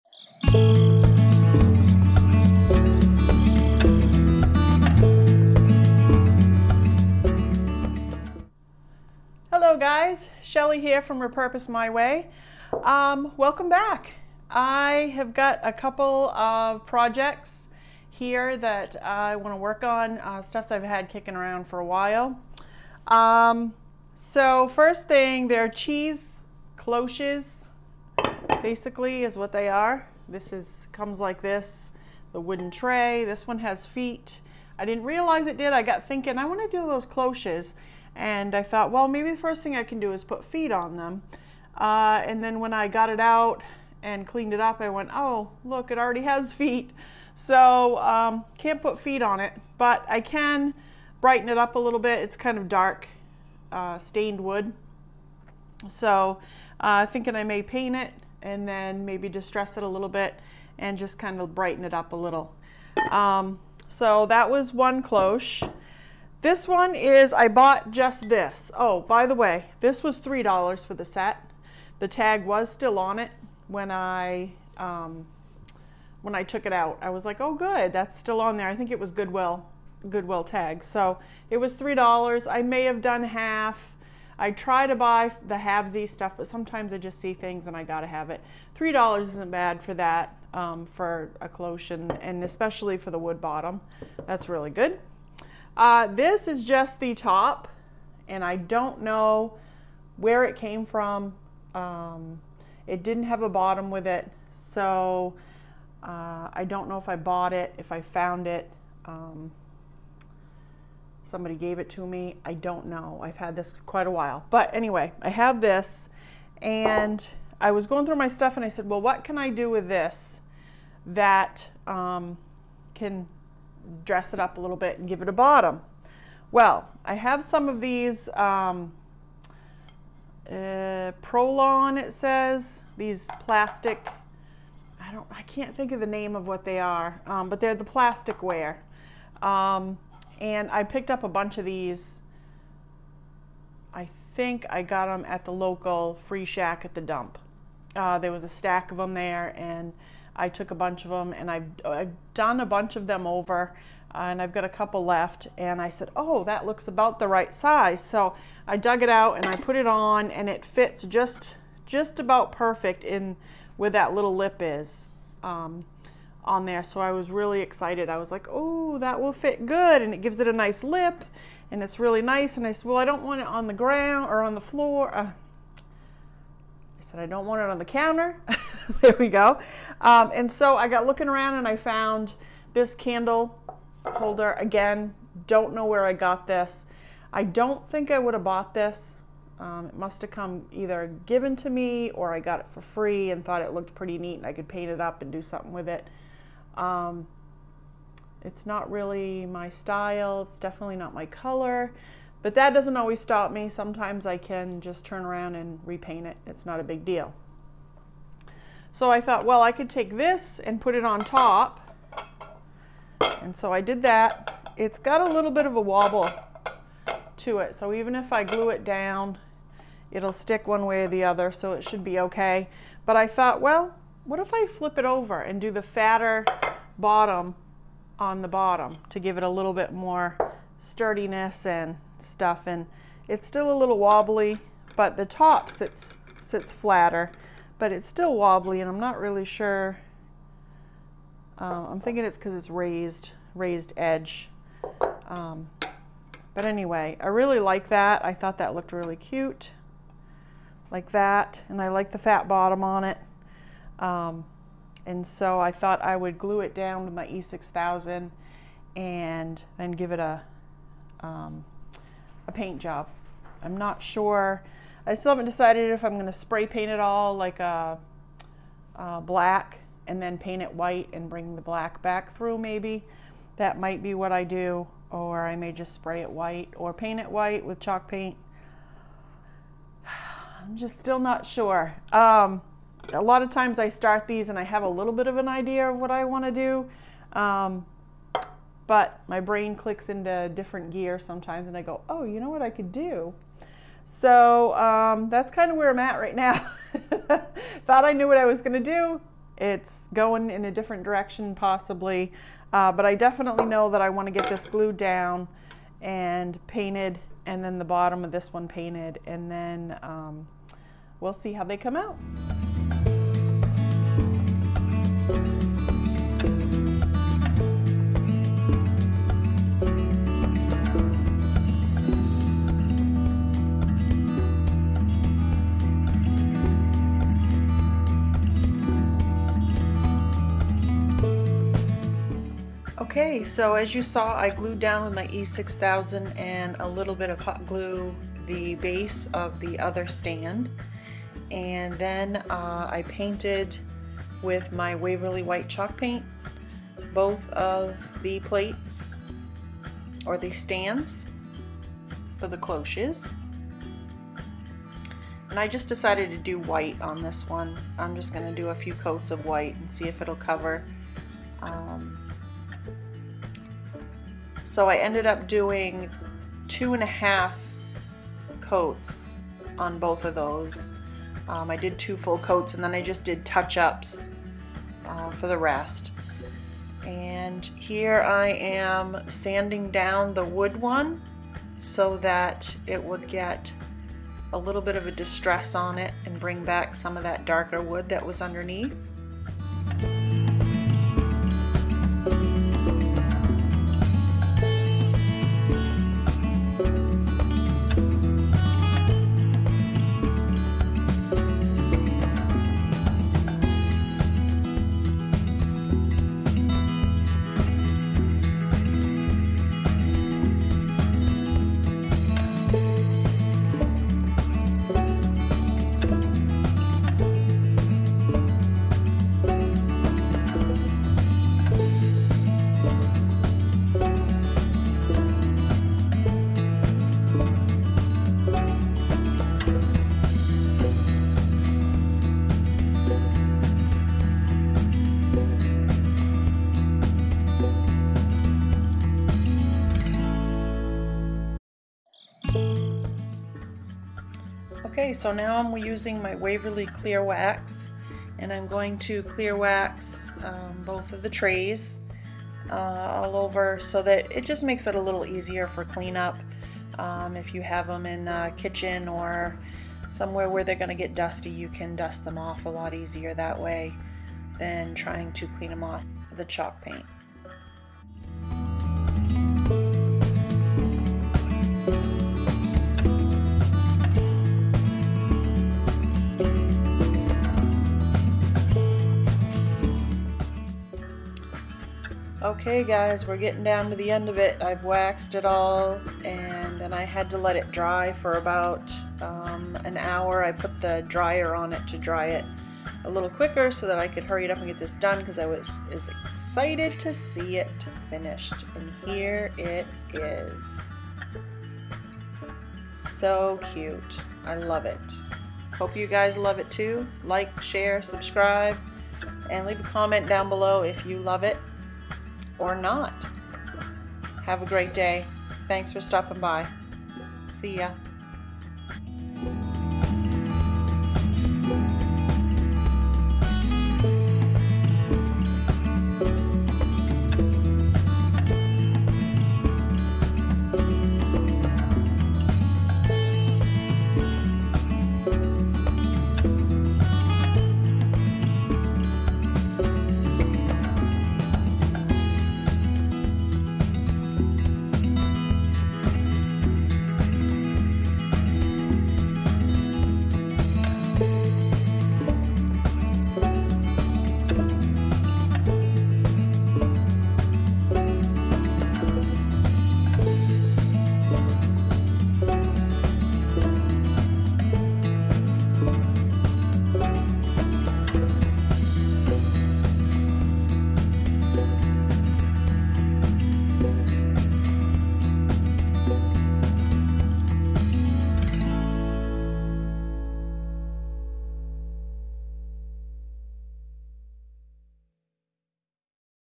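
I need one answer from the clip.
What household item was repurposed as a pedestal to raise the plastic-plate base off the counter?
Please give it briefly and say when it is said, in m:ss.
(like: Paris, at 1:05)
candle holder, at 3:02.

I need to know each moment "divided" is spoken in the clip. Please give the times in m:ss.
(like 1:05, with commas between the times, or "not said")
not said.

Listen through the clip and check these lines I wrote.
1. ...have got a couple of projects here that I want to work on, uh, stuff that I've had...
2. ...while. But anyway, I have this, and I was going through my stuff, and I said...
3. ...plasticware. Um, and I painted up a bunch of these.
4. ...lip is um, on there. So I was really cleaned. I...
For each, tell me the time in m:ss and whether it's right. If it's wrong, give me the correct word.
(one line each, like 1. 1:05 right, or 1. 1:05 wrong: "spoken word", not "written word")
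1. 0:15 right
2. 1:54 right
3. 2:17 wrong: "picked", not "painted"
4. 2:44 wrong: "excited", not "cleaned".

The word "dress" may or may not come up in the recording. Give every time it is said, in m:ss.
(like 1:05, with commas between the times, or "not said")
2:04.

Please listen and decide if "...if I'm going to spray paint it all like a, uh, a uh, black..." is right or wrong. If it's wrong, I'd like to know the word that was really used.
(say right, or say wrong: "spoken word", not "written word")
right.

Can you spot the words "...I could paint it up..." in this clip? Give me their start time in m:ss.
3:14.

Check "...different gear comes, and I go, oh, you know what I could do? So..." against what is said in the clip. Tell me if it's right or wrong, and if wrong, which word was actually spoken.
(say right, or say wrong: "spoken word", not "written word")
wrong: "sometimes", not "comes".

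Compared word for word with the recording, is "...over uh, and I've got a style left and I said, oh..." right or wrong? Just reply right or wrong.
wrong.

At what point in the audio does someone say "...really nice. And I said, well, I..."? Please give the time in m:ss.
2:51.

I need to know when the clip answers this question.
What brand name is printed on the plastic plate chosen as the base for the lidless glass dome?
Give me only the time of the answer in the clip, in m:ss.
2:11.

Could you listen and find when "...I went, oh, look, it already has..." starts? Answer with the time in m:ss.
0:44.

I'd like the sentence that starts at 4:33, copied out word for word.
That might be what I do or I may just spray it white or paint it white with chalk paint.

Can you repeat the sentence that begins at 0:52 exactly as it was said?
It's kind of dark uh, stained wood.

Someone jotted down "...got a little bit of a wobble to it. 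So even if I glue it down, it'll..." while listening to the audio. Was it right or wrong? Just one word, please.
right.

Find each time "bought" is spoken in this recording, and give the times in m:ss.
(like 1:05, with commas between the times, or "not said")
1:07, 1:47, 3:08.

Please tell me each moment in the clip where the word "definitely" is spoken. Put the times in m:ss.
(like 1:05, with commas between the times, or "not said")
3:20, 5:03.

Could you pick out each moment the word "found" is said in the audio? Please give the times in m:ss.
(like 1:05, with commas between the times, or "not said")
1:48, 3:01.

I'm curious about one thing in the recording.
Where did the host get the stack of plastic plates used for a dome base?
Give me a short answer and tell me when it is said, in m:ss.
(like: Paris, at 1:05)
local free shack at the dump, at 2:25.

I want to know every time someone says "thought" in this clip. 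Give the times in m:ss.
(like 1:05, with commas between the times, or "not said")
0:38, 3:13, 3:29, 3:43, 4:08, 4:15, 4:57.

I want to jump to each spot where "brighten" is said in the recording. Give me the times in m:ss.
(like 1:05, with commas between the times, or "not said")
0:51, 1:01.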